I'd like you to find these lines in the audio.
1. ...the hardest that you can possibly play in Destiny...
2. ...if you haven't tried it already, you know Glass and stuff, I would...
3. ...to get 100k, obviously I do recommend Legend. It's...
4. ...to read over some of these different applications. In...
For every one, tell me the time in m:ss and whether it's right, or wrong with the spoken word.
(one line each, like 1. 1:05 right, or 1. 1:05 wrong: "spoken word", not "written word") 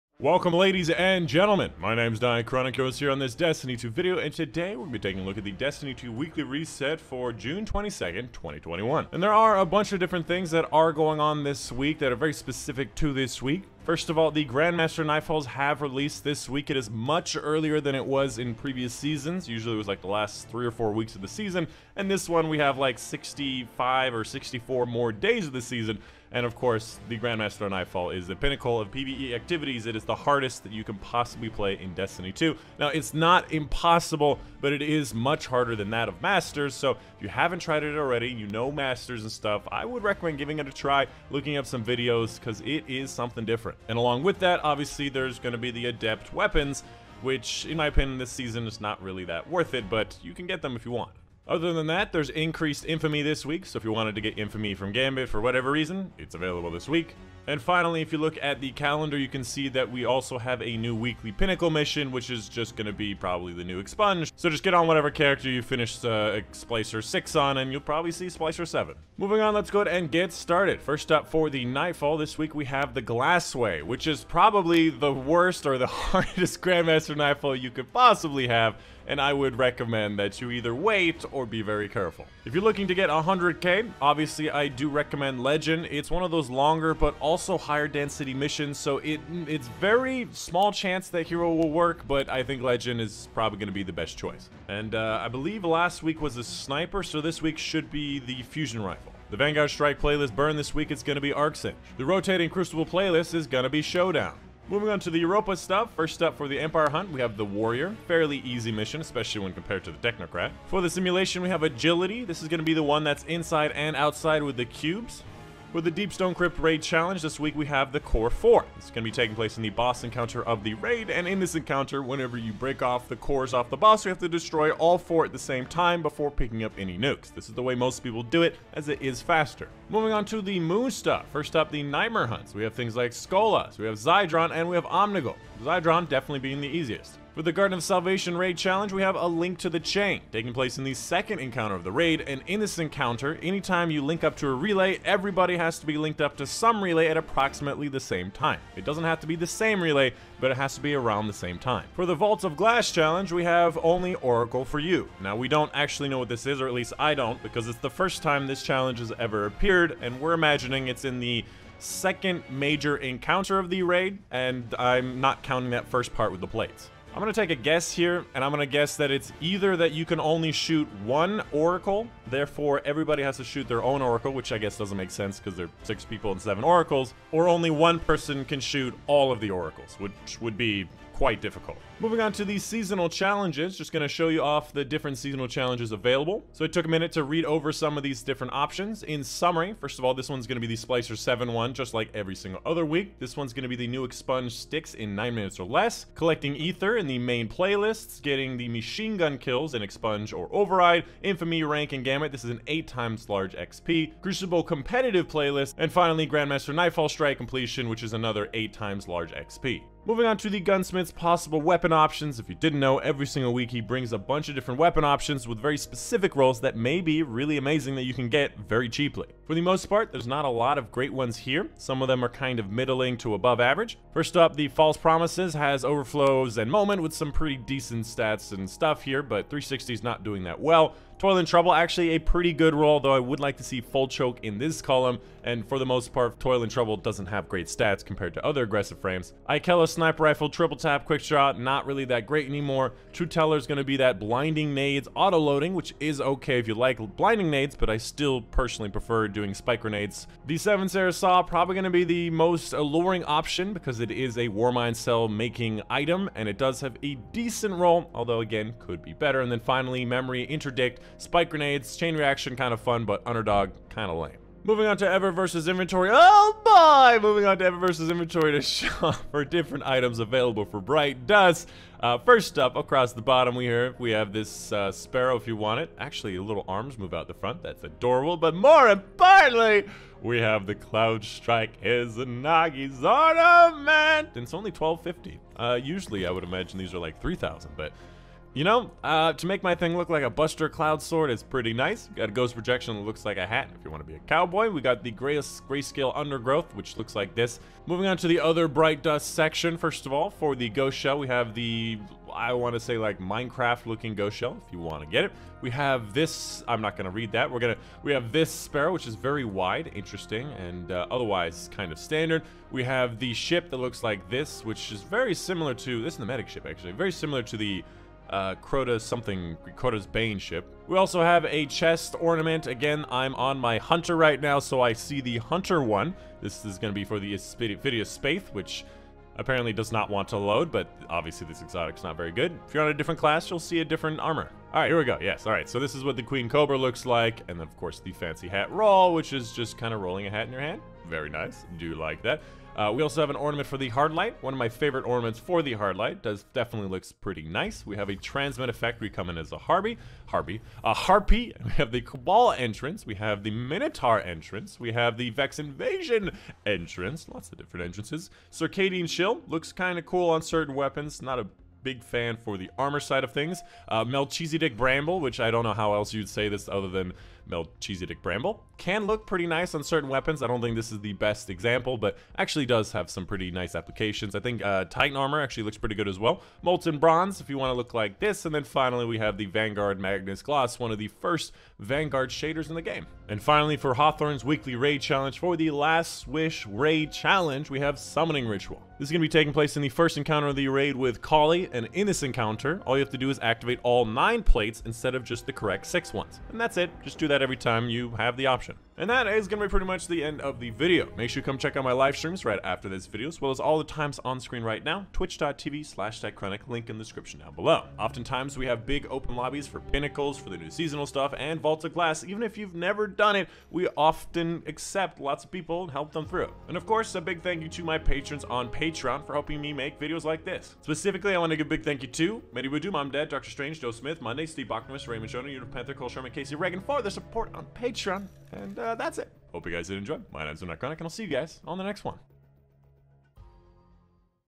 1. 0:30 right
2. 0:36 wrong: "Masters", not "Glass"
3. 1:22 right
4. 3:07 wrong: "options", not "applications".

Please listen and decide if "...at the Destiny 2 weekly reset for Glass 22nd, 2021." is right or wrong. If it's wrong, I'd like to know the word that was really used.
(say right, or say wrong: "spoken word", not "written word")
wrong: "June", not "Glass".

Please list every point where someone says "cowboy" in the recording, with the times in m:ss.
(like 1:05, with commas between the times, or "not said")
4:54.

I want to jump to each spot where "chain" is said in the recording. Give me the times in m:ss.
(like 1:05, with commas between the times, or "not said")
2:19, 4:21.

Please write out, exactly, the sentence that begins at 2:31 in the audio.
For the Vaults of Glass challenge, we have only Oracle for you.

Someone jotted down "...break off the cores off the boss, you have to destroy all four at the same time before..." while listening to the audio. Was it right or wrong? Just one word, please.
right.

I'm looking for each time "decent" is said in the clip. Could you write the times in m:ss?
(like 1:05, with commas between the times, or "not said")
3:47, 4:17.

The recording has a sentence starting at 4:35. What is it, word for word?
Actually, little arms move out the front.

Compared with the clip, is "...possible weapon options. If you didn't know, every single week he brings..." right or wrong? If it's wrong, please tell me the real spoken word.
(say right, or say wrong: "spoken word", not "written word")
right.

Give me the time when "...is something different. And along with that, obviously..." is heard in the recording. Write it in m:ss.
0:42.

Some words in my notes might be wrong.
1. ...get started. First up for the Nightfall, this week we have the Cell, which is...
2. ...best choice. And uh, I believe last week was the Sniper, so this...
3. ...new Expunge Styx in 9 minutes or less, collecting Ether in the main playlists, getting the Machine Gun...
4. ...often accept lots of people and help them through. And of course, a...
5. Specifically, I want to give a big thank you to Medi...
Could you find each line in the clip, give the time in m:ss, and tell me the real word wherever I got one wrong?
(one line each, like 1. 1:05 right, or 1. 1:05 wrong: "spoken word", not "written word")
1. 1:10 wrong: "Glassway", not "Cell"
2. 1:33 right
3. 3:13 right
4. 6:53 right
5. 7:00 right.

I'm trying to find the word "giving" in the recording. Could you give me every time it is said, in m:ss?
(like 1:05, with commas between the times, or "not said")
0:40.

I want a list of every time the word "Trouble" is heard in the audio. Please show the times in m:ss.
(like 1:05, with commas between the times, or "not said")
3:51, 3:56.